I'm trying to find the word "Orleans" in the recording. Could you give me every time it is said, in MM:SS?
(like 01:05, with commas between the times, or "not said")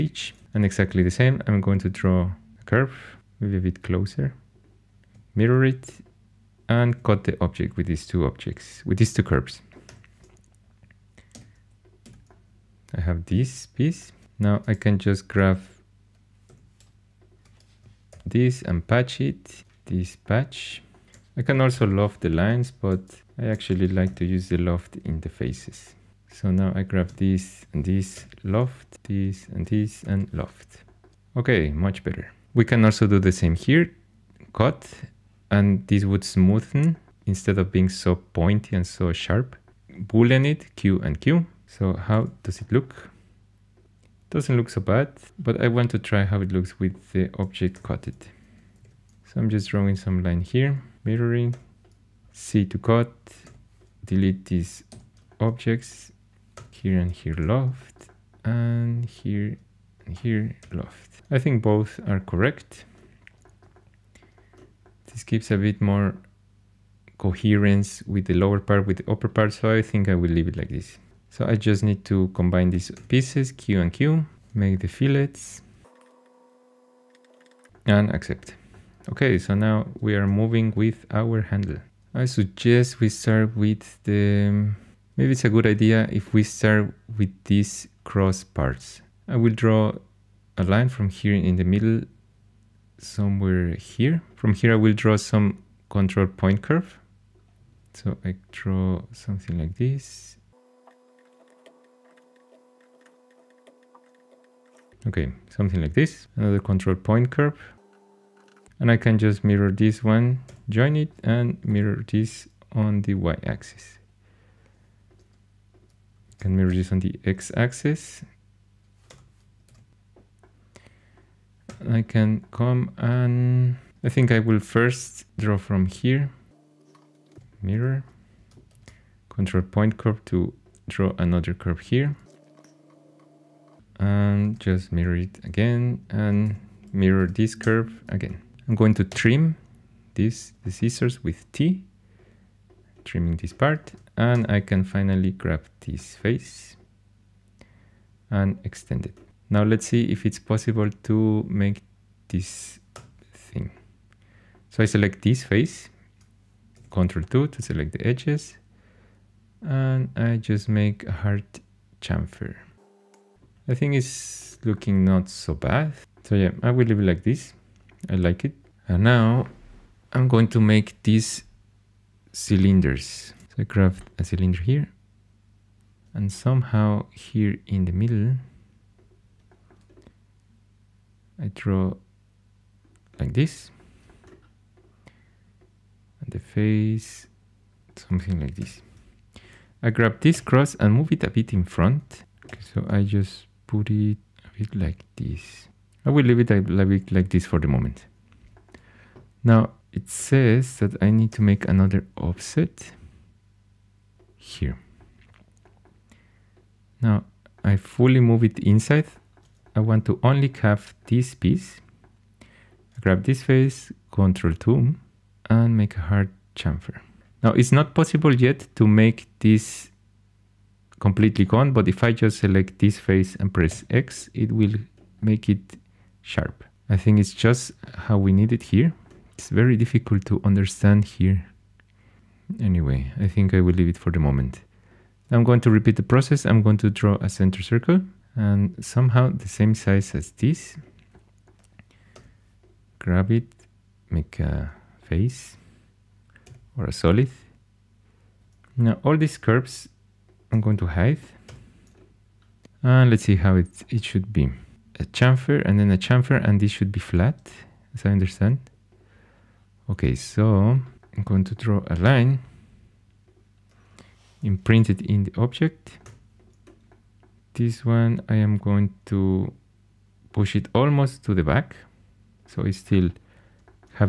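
not said.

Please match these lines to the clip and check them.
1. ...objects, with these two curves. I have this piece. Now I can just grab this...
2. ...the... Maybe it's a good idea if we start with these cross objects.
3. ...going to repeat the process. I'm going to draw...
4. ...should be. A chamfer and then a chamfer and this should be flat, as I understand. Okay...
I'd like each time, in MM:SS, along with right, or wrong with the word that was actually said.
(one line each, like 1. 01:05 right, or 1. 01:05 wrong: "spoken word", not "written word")
1. 00:08 right
2. 01:24 wrong: "parts", not "objects"
3. 03:55 right
4. 04:14 right.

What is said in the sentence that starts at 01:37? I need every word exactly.
So I draw something like this Okay, something like this, another control point curve.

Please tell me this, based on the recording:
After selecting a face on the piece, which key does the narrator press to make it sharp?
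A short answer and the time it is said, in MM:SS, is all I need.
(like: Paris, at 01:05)
X, at 03:43.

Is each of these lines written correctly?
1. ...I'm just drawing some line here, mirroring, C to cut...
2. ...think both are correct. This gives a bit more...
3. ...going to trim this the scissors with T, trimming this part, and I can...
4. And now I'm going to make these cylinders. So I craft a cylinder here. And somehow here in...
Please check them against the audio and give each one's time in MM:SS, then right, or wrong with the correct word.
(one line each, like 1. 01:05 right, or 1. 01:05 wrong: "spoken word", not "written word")
1. 00:49 right
2. 01:01 right
3. 02:18 right
4. 02:48 right.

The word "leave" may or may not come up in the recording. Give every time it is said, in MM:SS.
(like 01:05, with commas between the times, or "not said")
01:10, 02:46, 03:16, 03:53.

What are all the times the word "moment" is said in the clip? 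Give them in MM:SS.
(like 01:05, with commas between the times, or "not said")
03:17, 03:54.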